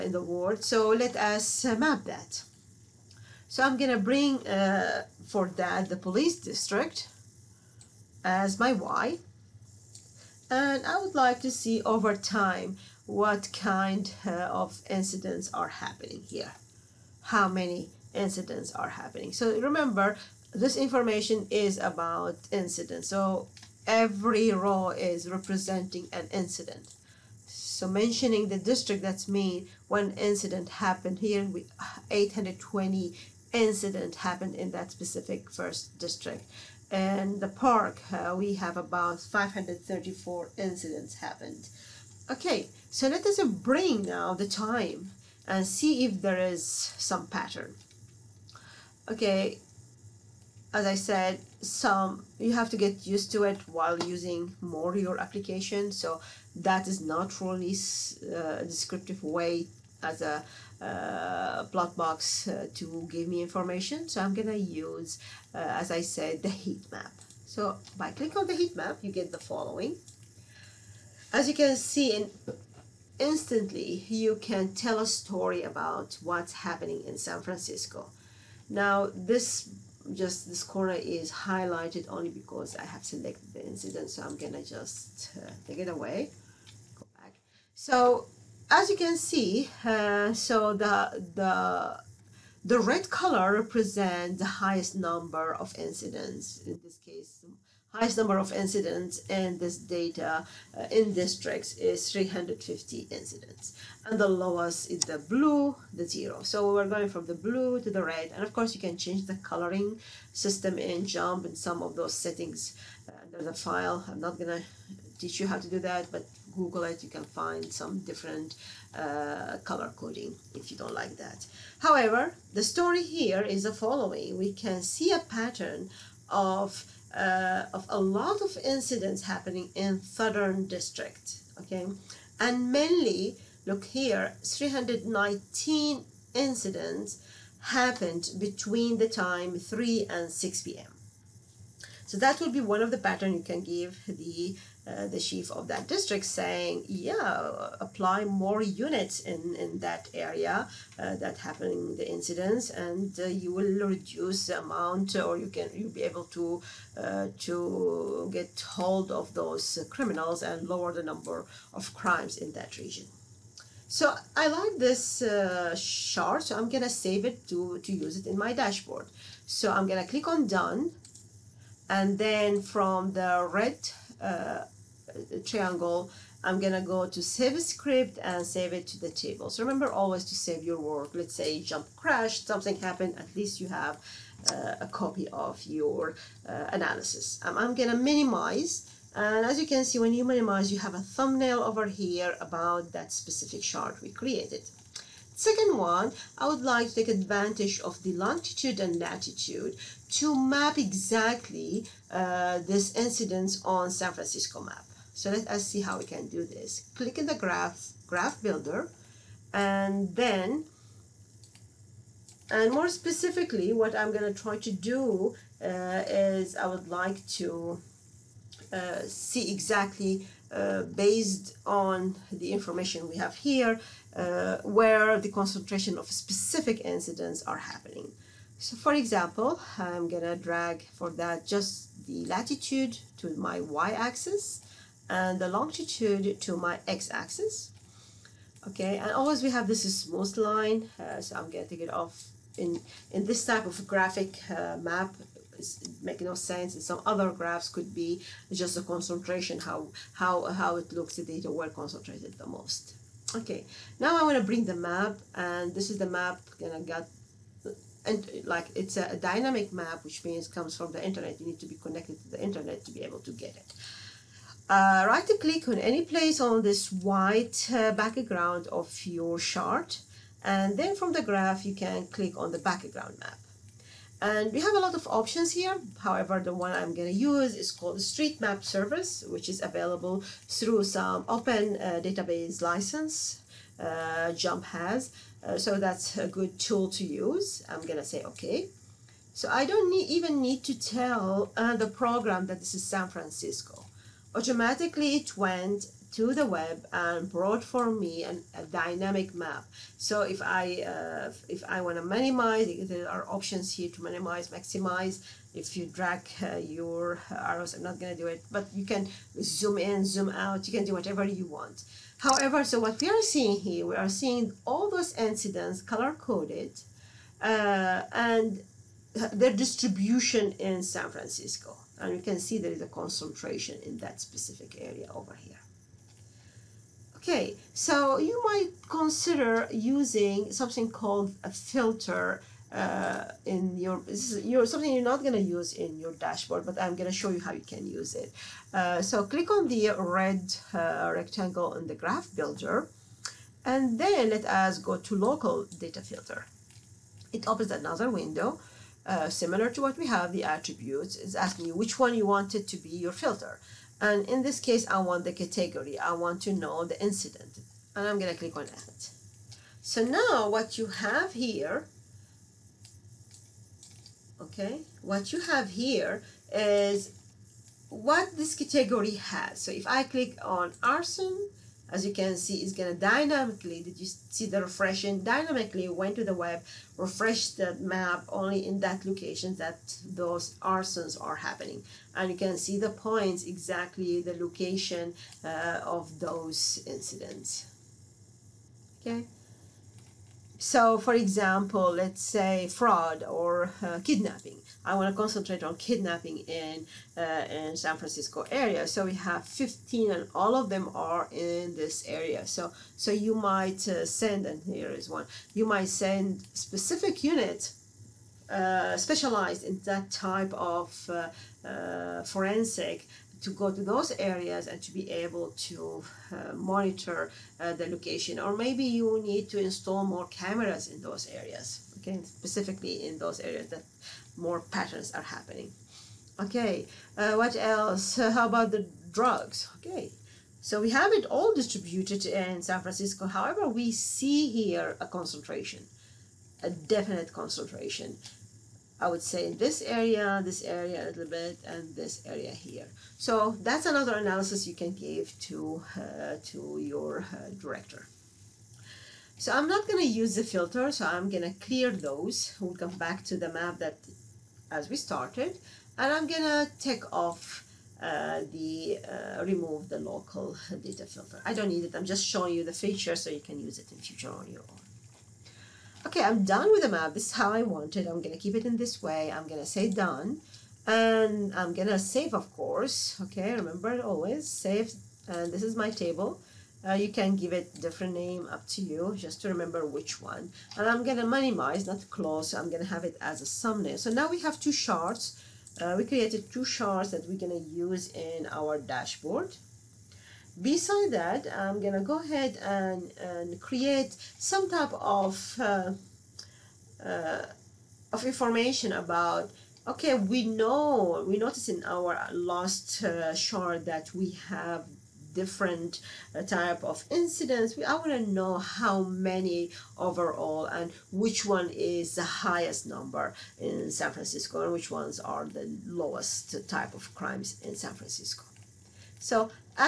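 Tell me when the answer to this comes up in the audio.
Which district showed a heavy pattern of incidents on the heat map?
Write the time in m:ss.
2:10.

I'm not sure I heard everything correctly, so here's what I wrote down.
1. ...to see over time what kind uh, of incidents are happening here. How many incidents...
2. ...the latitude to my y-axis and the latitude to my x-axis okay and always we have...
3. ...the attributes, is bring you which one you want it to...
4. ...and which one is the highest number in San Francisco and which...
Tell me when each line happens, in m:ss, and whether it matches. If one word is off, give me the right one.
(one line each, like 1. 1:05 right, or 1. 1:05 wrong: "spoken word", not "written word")
1. 0:11 right
2. 3:52 wrong: "longitude", not "latitude"
3. 5:50 wrong: "asking", not "bring"
4. 8:30 right.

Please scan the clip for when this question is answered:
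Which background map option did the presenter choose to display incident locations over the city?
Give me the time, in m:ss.
4:37.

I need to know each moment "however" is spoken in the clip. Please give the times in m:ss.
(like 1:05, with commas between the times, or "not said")
2:01, 4:36, 5:12, 7:13.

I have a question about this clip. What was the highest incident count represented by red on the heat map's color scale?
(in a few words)
350.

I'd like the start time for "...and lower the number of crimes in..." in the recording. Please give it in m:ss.
2:40.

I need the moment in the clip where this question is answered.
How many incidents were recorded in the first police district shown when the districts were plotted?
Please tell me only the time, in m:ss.
0:32.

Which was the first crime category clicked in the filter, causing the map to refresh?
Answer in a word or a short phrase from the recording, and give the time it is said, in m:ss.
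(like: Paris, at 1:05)
arson, at 6:10.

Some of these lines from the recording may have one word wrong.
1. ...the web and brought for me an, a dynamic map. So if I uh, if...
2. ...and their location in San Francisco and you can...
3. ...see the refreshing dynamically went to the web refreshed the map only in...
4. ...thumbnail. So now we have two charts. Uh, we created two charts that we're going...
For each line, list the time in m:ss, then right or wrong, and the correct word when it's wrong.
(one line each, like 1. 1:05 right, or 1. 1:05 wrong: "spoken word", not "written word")
1. 4:56 right
2. 5:18 wrong: "distribution", not "location"
3. 6:14 right
4. 8:03 right.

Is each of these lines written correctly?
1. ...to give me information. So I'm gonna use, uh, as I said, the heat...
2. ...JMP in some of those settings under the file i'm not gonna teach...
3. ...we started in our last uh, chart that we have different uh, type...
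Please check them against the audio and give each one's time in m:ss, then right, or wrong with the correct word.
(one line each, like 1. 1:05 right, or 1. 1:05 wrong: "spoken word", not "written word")
1. 1:02 right
2. 1:51 right
3. 8:21 wrong: "noticed", not "started".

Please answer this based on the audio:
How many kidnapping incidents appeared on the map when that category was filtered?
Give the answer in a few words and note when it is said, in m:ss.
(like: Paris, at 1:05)
15, at 6:39.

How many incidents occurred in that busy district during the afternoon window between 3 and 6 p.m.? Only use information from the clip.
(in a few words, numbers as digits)
319.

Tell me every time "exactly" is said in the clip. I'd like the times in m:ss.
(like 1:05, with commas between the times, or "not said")
3:20, 3:39, 6:23.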